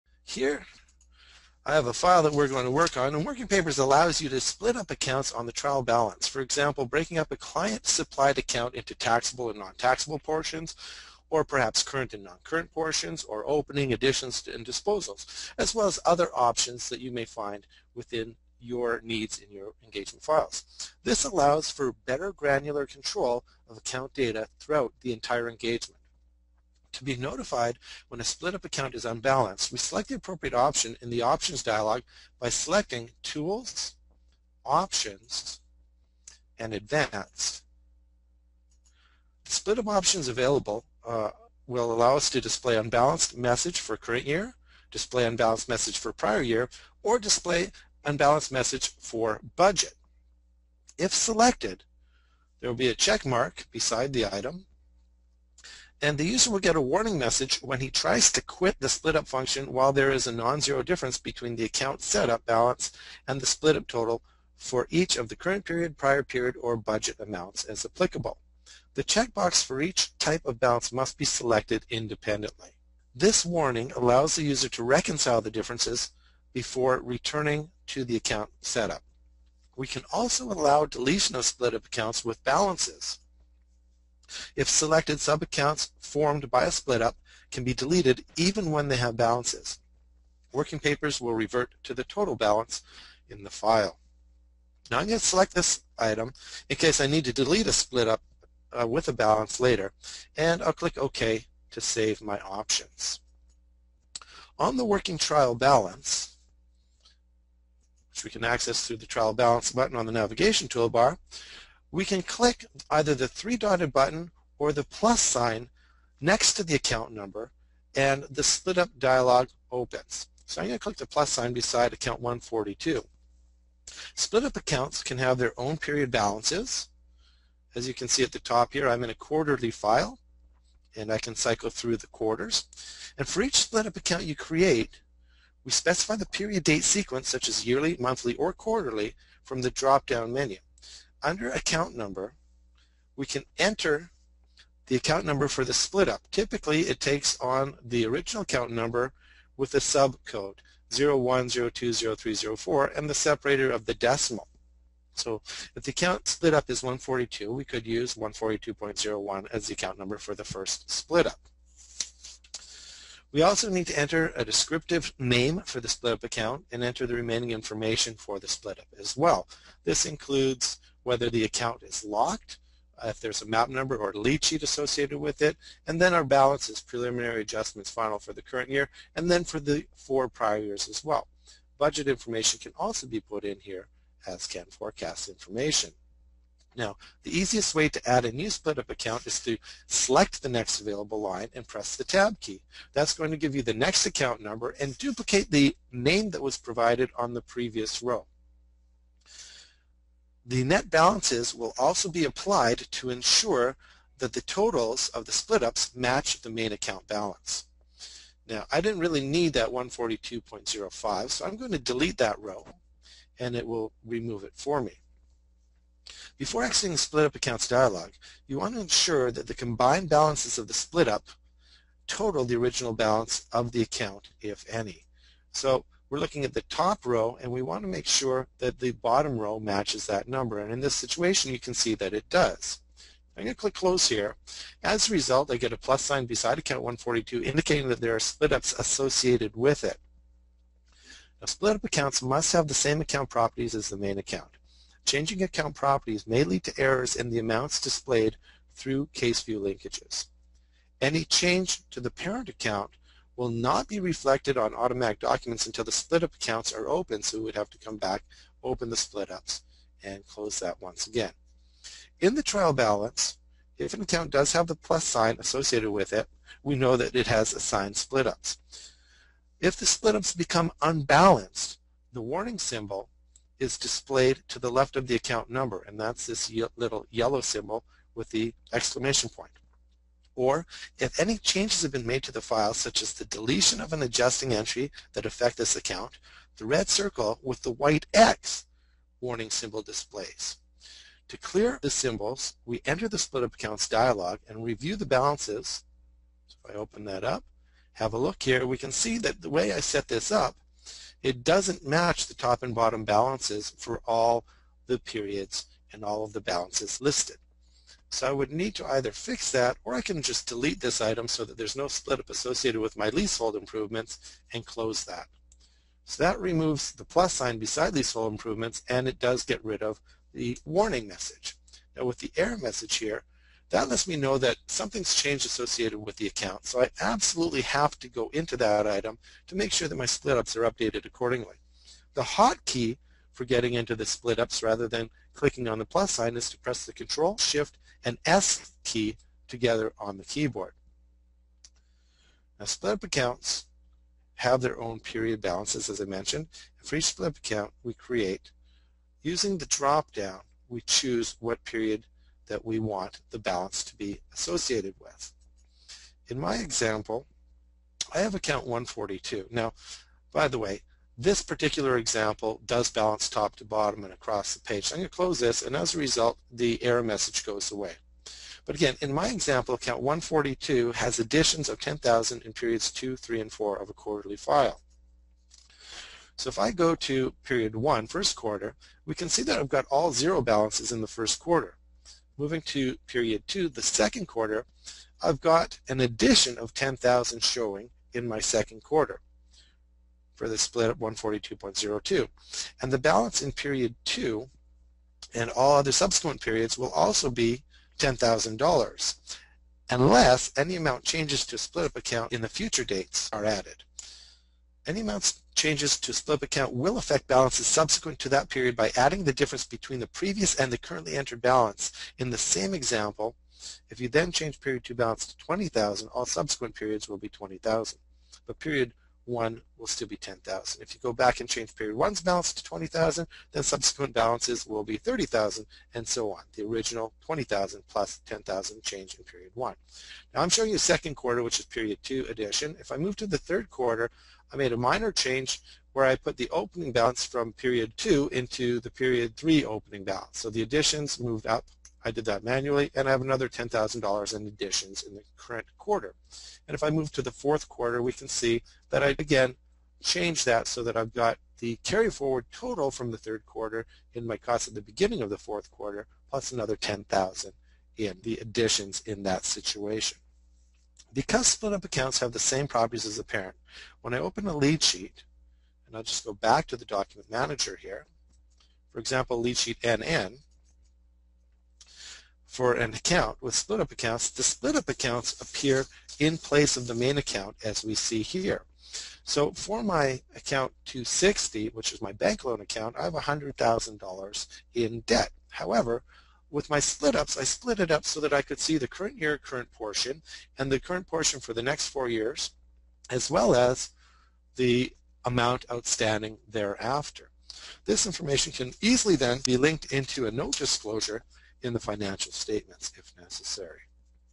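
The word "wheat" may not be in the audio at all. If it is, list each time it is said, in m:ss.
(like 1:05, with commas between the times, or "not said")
not said.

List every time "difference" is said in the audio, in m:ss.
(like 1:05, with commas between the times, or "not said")
1:00, 1:15, 6:49.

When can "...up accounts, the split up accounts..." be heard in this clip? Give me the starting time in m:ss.
7:53.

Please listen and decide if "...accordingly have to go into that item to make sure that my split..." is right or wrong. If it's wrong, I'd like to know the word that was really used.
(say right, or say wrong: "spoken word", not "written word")
wrong: "absolutely", not "accordingly".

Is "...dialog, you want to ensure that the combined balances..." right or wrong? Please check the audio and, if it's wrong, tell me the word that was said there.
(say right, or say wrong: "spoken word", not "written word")
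right.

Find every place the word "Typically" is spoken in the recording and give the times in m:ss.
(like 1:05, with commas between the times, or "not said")
2:26.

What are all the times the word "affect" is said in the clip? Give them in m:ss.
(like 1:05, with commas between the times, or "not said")
4:45, 6:46.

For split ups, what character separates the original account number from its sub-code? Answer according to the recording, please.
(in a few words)
decimal.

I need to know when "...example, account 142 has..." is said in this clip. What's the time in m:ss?
6:09.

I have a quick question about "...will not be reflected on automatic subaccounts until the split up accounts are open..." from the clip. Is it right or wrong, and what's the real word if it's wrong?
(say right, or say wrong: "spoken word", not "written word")
wrong: "documents", not "subaccounts".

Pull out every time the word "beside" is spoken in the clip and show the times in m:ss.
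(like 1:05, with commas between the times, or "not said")
0:53, 2:01, 3:56, 5:17.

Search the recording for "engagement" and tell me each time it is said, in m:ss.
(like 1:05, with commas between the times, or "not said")
0:19, 0:25.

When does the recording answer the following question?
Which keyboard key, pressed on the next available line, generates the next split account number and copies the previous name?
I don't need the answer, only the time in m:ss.
3:12.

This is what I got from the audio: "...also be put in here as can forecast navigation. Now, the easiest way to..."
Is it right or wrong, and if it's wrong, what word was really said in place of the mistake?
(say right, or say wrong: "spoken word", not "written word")
wrong: "information", not "navigation".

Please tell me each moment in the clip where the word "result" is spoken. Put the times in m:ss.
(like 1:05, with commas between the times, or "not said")
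3:55, 6:05.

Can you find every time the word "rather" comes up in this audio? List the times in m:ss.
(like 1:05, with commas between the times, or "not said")
5:34.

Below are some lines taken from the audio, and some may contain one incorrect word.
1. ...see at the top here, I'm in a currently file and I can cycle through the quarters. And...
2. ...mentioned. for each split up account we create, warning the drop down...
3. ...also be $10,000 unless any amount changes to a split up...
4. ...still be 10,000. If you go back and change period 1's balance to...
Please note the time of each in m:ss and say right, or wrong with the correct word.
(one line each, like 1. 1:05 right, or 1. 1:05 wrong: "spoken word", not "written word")
1. 2:08 wrong: "quarterly", not "currently"
2. 5:46 wrong: "using", not "warning"
3. 6:36 right
4. 6:59 right.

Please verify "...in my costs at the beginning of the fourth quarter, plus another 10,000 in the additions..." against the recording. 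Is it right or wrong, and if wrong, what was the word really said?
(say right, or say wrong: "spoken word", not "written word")
right.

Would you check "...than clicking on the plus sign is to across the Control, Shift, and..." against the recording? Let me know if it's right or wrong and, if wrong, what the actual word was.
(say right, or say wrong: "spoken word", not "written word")
wrong: "press", not "across".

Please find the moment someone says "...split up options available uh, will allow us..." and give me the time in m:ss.
0:39.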